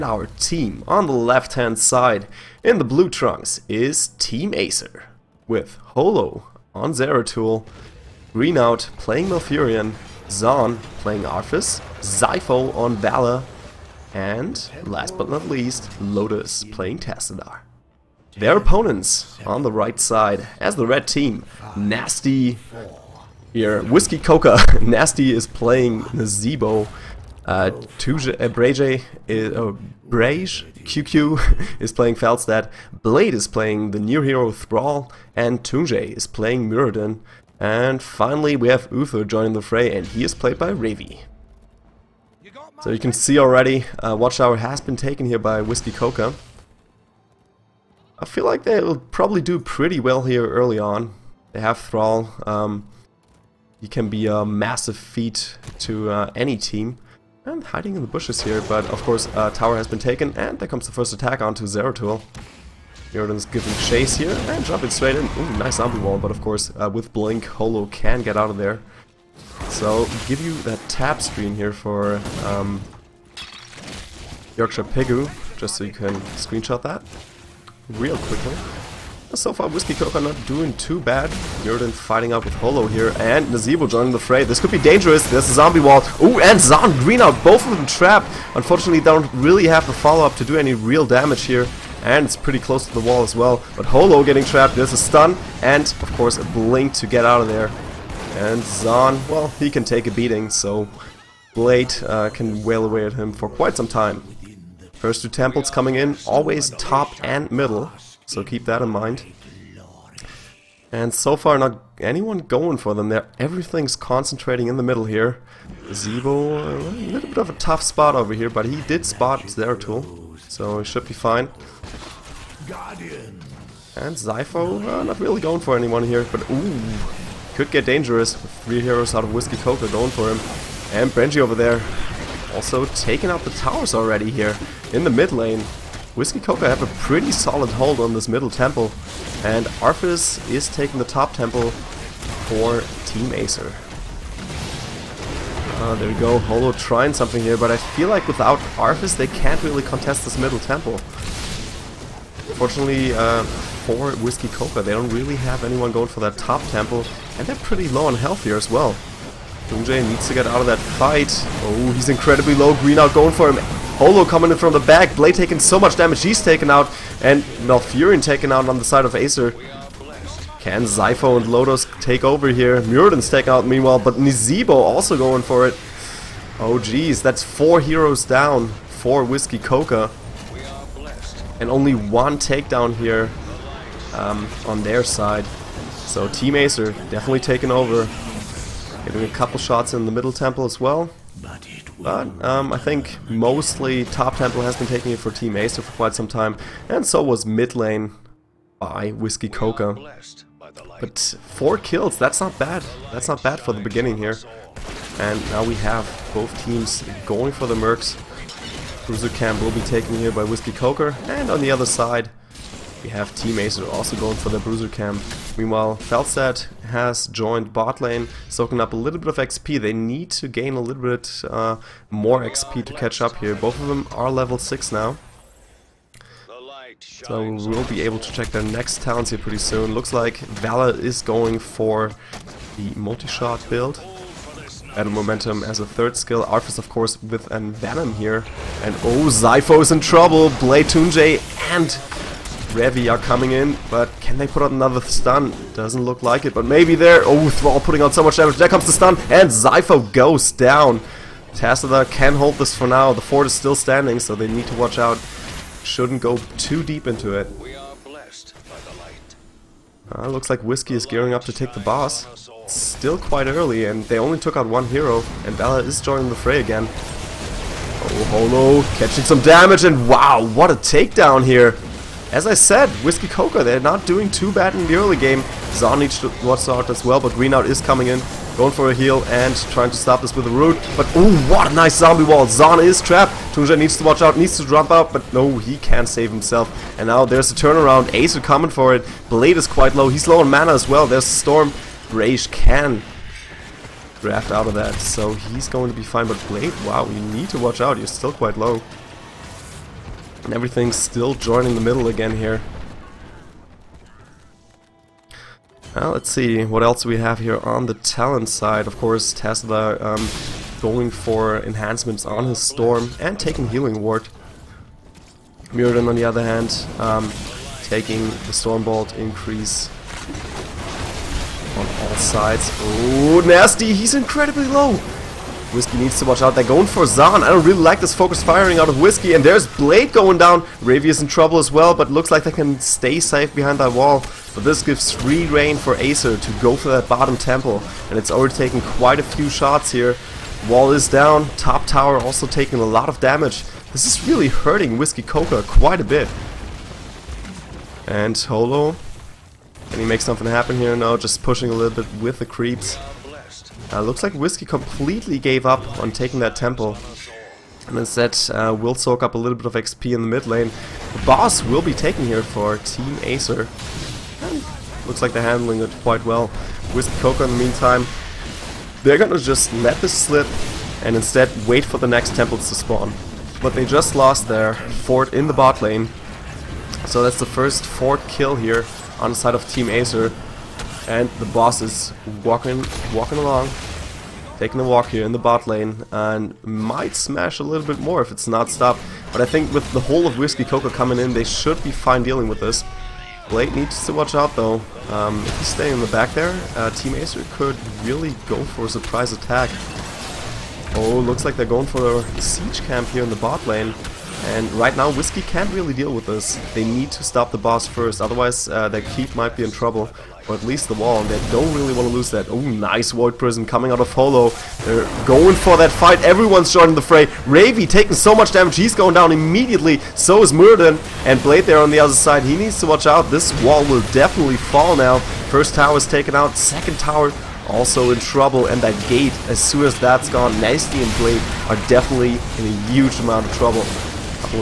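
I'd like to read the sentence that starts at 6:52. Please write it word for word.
Oh, nice Void Prison coming out of Holo.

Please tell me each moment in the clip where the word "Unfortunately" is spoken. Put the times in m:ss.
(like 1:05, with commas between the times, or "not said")
1:28.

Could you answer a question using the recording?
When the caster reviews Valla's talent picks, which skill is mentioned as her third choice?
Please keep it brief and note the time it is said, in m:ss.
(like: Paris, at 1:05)
Battle Momentum, at 3:54.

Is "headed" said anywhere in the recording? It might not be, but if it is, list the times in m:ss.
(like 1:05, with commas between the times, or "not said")
not said.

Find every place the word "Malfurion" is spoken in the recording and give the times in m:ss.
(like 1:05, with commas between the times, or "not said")
0:09, 2:47.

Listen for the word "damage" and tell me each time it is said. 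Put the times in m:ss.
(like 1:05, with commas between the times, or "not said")
1:31, 2:45, 4:08, 4:29, 5:43, 6:58.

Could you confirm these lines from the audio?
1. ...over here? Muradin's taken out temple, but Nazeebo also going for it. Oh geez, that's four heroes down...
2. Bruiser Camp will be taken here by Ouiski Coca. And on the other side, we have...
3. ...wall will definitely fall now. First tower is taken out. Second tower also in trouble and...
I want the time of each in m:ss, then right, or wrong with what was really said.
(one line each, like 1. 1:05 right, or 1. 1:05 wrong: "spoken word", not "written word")
1. 2:52 wrong: "meanwhile", not "temple"
2. 3:29 right
3. 7:03 right.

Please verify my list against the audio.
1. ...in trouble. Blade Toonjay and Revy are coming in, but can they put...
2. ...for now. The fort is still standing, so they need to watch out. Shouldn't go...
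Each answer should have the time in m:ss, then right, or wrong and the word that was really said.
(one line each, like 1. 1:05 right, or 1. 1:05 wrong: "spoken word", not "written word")
1. 3:59 right
2. 4:12 right.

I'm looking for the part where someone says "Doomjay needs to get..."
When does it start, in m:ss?
2:39.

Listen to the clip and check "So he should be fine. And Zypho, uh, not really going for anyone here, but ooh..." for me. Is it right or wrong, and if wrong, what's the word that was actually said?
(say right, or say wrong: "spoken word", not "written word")
right.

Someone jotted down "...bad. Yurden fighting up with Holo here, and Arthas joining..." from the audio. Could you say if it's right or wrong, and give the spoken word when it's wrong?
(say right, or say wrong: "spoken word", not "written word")
wrong: "Nazeebo", not "Arthas".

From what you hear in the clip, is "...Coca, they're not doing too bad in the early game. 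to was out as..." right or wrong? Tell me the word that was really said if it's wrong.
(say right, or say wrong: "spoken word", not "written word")
right.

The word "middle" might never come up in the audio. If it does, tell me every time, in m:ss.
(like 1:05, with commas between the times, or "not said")
1:47, 1:54, 2:18, 2:30, 3:10, 5:01.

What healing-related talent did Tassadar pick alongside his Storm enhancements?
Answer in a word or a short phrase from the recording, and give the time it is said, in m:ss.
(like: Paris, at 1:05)
Healing Ward, at 5:13.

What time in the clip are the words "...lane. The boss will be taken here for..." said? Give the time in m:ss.
6:00.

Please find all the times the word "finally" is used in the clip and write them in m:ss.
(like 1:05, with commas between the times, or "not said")
0:38.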